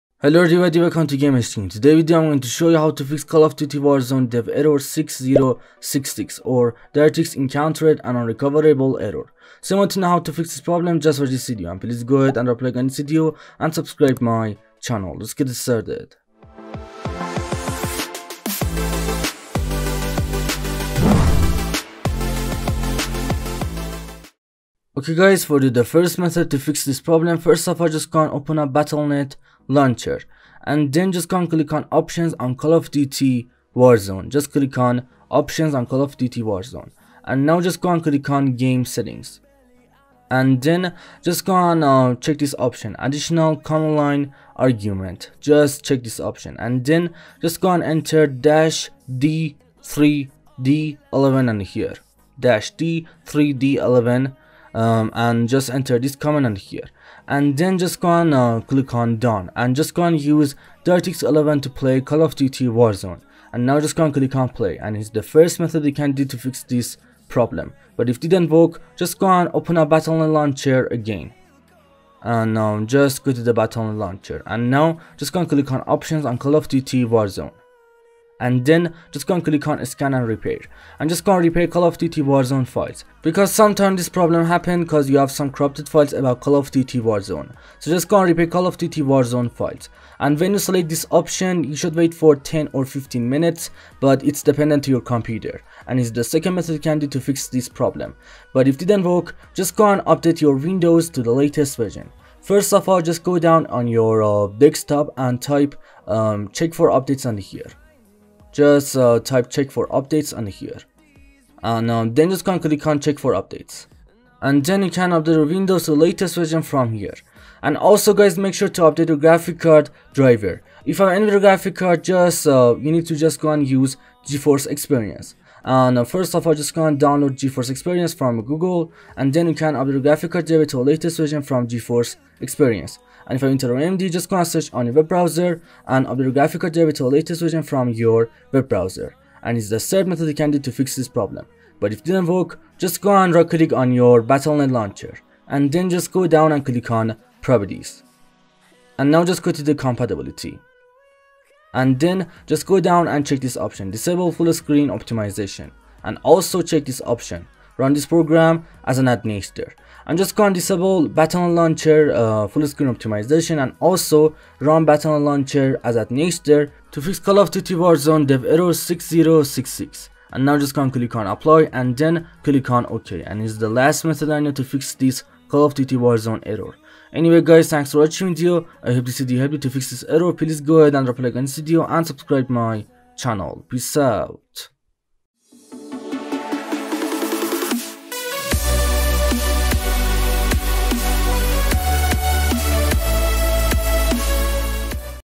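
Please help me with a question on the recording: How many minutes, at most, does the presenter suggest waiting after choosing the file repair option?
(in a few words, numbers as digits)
15.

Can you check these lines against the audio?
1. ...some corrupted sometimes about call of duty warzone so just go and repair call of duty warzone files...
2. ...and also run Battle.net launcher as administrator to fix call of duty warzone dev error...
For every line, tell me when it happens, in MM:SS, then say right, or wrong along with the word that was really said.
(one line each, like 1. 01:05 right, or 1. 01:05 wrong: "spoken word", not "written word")
1. 01:25 wrong: "files", not "sometimes"
2. 02:43 right.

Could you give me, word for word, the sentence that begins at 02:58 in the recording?
I hope this video helped you to fix this error.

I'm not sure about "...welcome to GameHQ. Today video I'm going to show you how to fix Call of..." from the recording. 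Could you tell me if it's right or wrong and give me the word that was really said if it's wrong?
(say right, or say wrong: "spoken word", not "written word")
right.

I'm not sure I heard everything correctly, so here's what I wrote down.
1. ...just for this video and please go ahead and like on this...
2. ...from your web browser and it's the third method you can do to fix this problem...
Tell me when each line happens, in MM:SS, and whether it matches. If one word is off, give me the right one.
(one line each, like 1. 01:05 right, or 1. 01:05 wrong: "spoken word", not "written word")
1. 00:10 right
2. 02:17 right.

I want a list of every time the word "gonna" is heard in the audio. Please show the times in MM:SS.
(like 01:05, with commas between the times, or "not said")
02:06, 02:14.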